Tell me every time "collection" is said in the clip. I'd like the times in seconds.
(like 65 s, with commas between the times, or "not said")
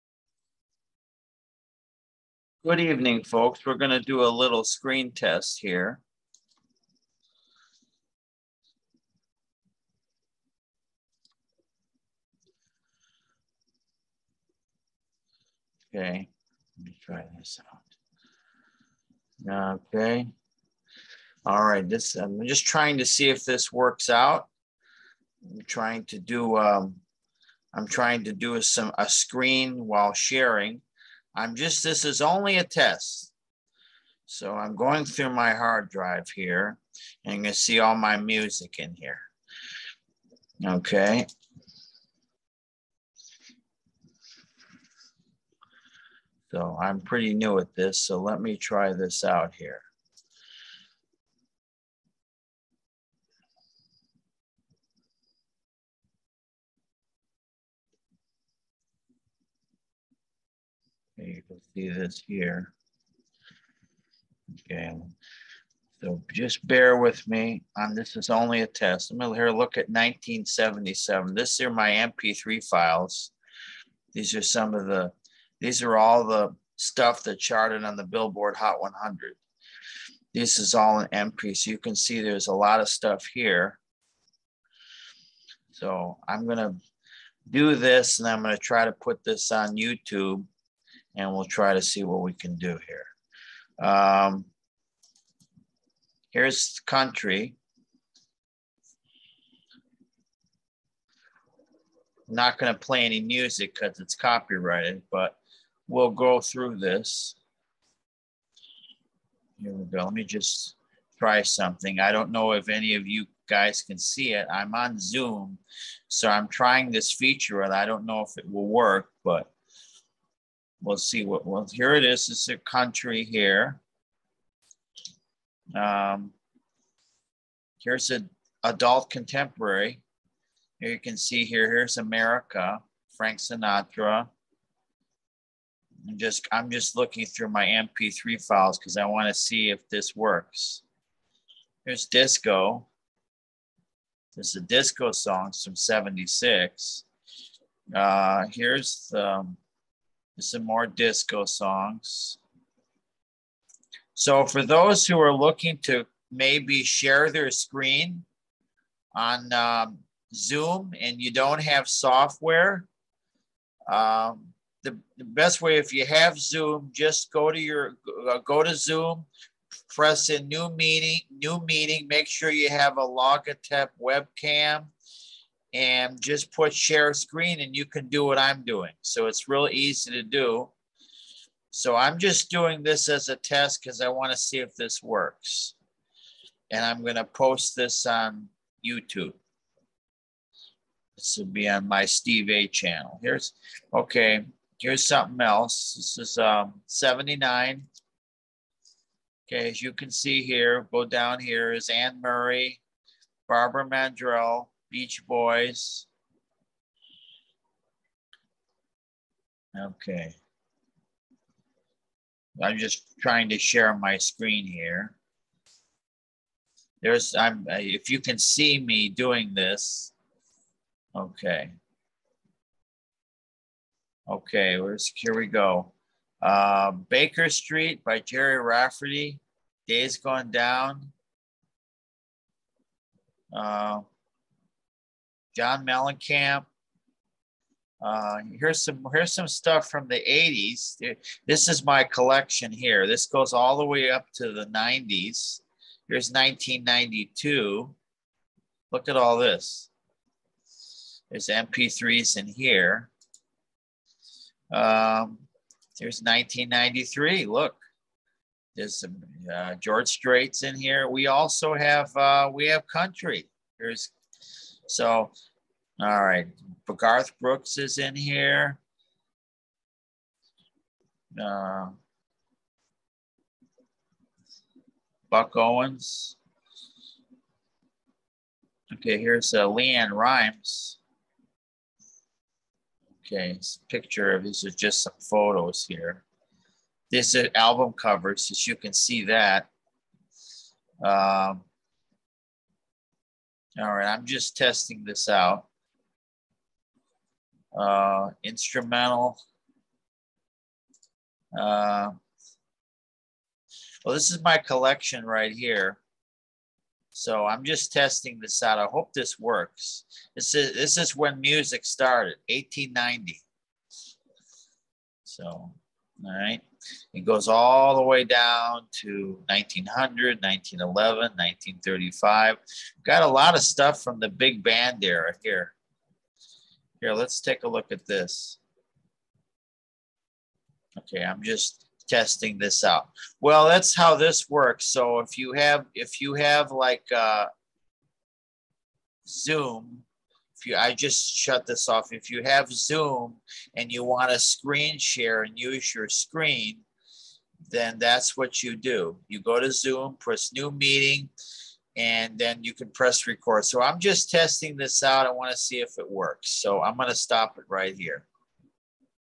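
242 s, 304 s.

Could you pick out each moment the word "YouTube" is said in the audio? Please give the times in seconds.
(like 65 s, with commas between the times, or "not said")
89 s, 188 s.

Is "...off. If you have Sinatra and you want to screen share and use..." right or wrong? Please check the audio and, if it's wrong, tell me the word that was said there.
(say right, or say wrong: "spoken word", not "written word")
wrong: "Zoom", not "Sinatra".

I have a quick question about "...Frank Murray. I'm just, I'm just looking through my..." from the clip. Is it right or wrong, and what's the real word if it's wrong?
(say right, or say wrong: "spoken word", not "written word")
wrong: "Sinatra", not "Murray".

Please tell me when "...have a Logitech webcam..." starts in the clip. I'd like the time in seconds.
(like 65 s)
172 s.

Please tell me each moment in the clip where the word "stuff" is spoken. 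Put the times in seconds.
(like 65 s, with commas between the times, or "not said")
76 s, 82 s, 239 s, 323 s.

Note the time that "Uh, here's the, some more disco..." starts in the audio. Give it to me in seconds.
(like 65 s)
147 s.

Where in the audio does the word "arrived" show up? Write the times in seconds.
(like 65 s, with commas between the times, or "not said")
not said.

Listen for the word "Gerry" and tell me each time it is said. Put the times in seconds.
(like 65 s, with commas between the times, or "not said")
228 s.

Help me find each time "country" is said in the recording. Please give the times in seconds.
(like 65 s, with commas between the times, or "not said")
96 s, 122 s, 262 s.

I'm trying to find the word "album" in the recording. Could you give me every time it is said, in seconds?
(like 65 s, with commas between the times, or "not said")
287 s.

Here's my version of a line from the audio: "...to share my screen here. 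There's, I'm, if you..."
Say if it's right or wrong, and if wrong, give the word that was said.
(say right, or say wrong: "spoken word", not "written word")
right.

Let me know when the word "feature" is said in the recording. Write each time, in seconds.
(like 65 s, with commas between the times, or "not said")
117 s.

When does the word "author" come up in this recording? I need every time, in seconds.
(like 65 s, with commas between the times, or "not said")
not said.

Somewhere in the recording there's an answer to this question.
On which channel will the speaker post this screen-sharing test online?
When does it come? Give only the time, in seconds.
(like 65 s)
192 s.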